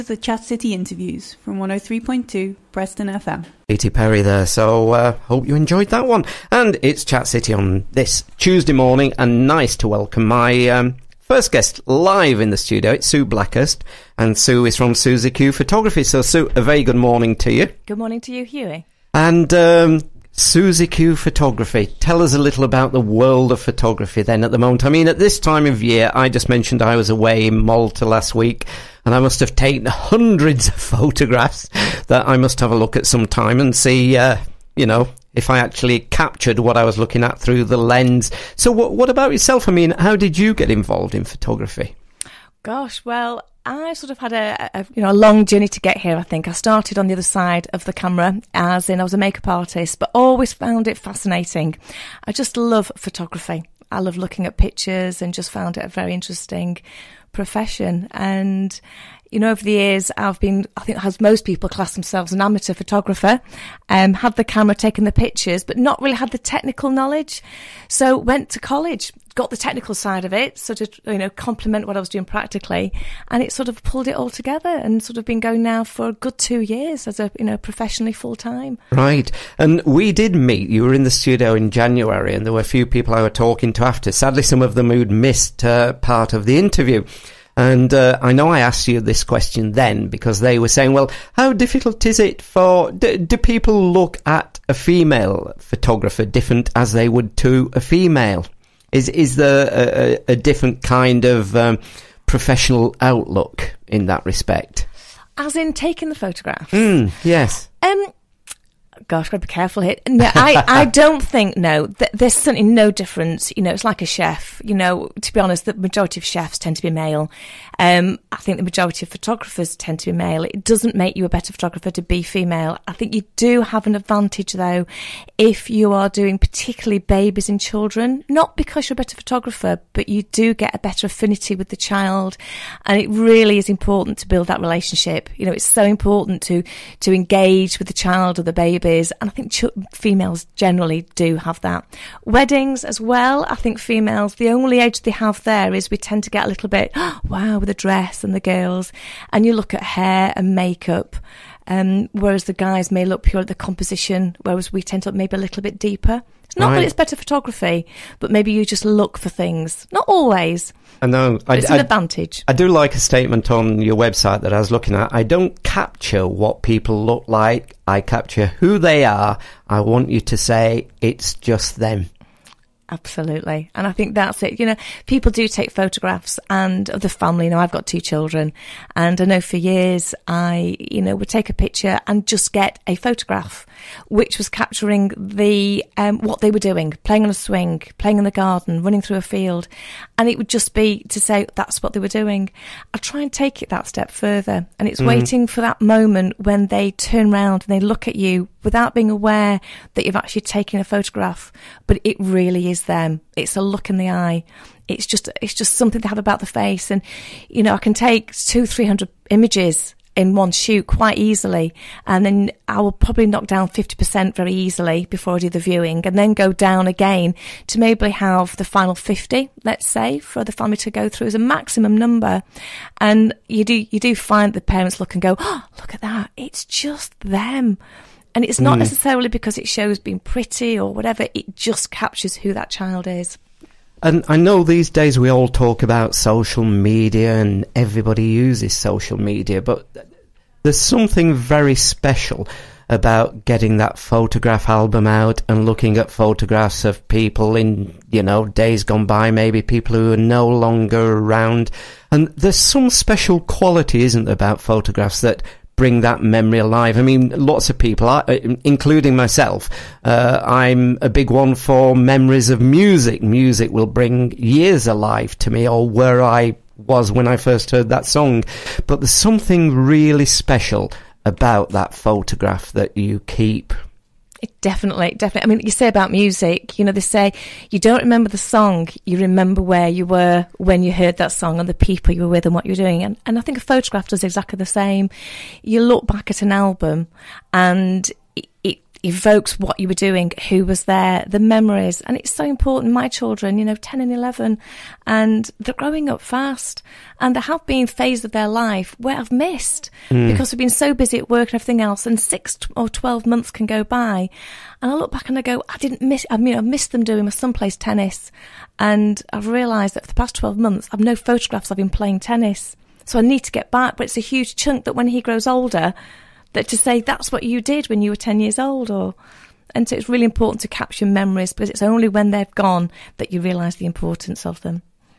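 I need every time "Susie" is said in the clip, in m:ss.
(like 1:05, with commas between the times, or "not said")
0:14, 0:20.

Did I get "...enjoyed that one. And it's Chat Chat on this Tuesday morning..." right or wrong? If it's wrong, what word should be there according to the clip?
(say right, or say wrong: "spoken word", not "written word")
wrong: "City", not "Chat".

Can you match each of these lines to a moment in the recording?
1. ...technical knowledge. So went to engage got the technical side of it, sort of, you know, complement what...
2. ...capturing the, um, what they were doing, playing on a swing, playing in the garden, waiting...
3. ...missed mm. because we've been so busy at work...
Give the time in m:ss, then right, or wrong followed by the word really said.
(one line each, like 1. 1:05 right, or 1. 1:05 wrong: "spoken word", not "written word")
1. 1:06 wrong: "college", not "engage"
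2. 3:04 wrong: "running", not "waiting"
3. 4:59 right.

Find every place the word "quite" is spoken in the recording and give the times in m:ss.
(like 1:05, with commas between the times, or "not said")
3:30.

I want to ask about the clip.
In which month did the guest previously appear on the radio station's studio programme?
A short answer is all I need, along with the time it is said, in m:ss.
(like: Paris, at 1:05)
January, at 1:21.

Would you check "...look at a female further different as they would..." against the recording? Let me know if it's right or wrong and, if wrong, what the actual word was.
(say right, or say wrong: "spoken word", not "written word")
wrong: "photographer", not "further".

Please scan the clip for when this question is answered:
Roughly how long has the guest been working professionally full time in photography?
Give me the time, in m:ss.
1:16.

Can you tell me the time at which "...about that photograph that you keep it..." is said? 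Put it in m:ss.
4:31.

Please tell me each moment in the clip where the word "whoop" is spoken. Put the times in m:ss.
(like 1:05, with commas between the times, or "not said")
not said.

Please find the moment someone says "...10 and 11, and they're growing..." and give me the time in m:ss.
4:53.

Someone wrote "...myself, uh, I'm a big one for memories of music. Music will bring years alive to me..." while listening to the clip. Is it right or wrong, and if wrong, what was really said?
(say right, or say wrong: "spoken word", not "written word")
right.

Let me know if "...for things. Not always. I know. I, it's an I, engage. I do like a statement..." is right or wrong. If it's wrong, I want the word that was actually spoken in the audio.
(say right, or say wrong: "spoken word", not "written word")
wrong: "advantage", not "engage".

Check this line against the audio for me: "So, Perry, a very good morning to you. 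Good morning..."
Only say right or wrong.
wrong.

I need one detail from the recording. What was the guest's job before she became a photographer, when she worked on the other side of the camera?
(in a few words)
Makeup artist.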